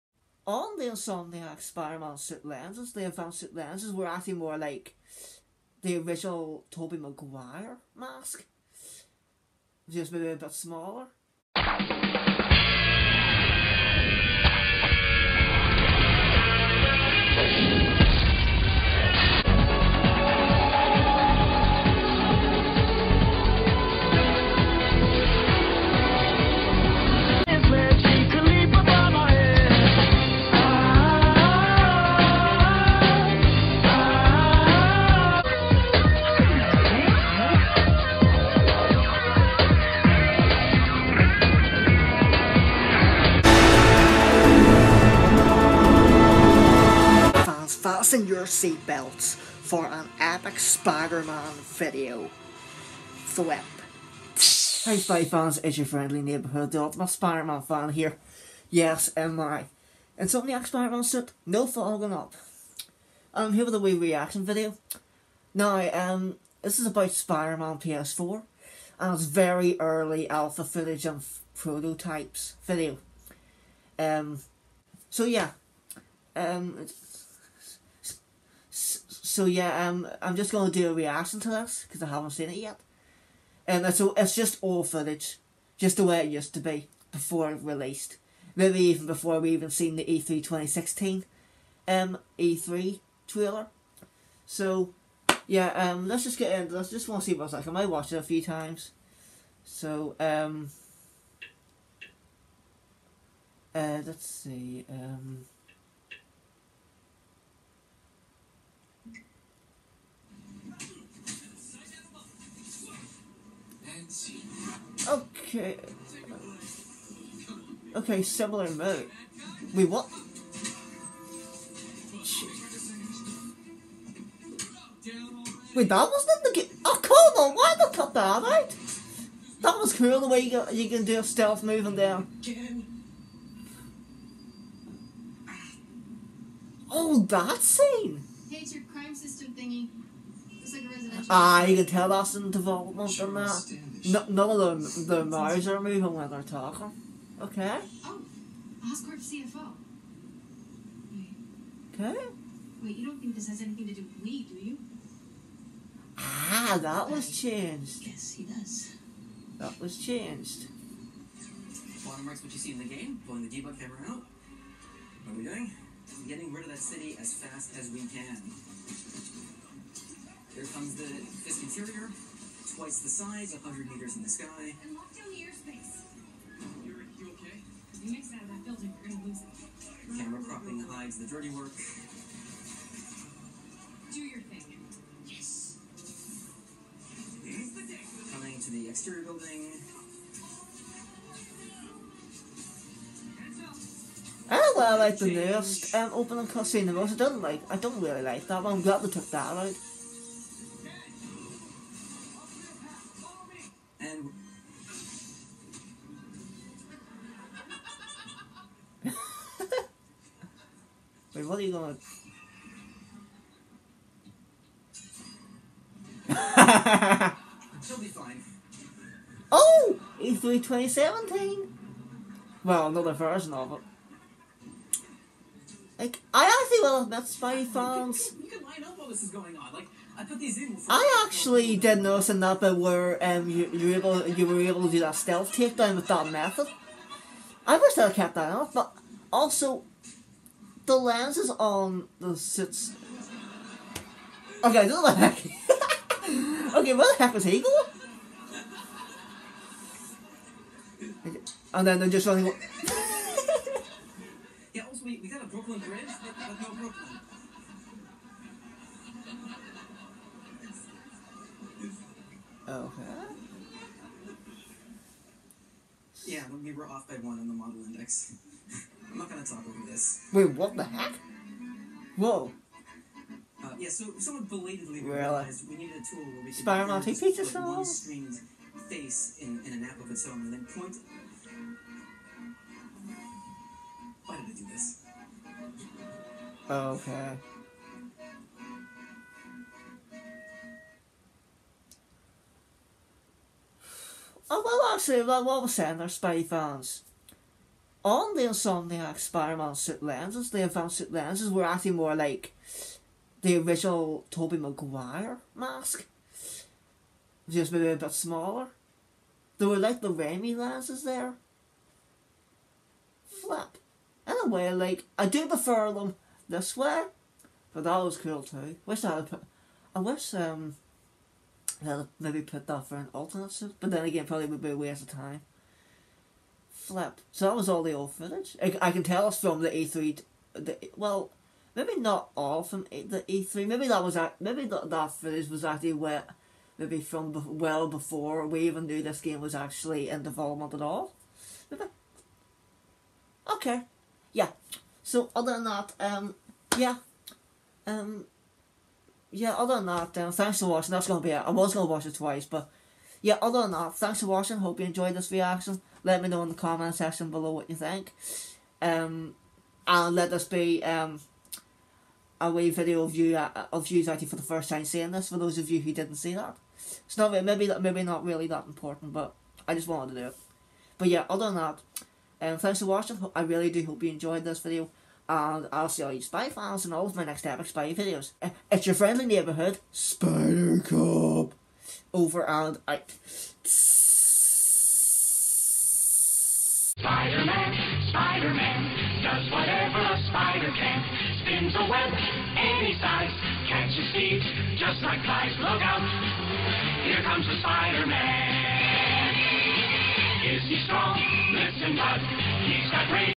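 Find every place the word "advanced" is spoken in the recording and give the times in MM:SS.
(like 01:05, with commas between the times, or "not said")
00:03, 05:00.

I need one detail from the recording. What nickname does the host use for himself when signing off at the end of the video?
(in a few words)
Spider Cop.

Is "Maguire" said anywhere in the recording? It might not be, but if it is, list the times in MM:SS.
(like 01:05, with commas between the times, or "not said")
00:06, 05:04.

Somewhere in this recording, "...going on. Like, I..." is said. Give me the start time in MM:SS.
03:49.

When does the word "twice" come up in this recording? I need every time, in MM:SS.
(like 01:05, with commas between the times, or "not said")
02:52, 05:52.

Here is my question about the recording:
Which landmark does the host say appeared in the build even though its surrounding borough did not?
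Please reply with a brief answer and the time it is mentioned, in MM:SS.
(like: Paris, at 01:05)
Brooklyn Bridge, at 04:15.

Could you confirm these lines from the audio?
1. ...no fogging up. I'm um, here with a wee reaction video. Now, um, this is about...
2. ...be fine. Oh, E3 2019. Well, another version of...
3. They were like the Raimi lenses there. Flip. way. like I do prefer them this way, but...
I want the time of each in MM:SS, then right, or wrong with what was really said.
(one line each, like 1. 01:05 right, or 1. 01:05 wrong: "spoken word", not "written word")
1. 01:01 right
2. 03:37 wrong: "2017", not "2019"
3. 05:09 right.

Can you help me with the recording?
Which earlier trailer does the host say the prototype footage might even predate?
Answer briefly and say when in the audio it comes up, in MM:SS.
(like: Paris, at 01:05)
E3 2016, at 01:30.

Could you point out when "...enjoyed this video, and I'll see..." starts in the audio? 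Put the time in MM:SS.
06:14.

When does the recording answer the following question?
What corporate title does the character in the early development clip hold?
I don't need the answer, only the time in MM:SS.
02:28.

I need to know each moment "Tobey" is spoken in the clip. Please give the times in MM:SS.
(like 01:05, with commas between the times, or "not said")
00:06, 05:04.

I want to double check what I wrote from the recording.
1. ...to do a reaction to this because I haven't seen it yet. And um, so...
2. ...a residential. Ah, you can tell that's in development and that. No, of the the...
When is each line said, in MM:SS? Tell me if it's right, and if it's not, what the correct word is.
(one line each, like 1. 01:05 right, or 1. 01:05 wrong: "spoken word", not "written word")
1. 01:20 right
2. 02:20 right.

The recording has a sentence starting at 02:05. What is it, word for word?
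Wait, that was not the game.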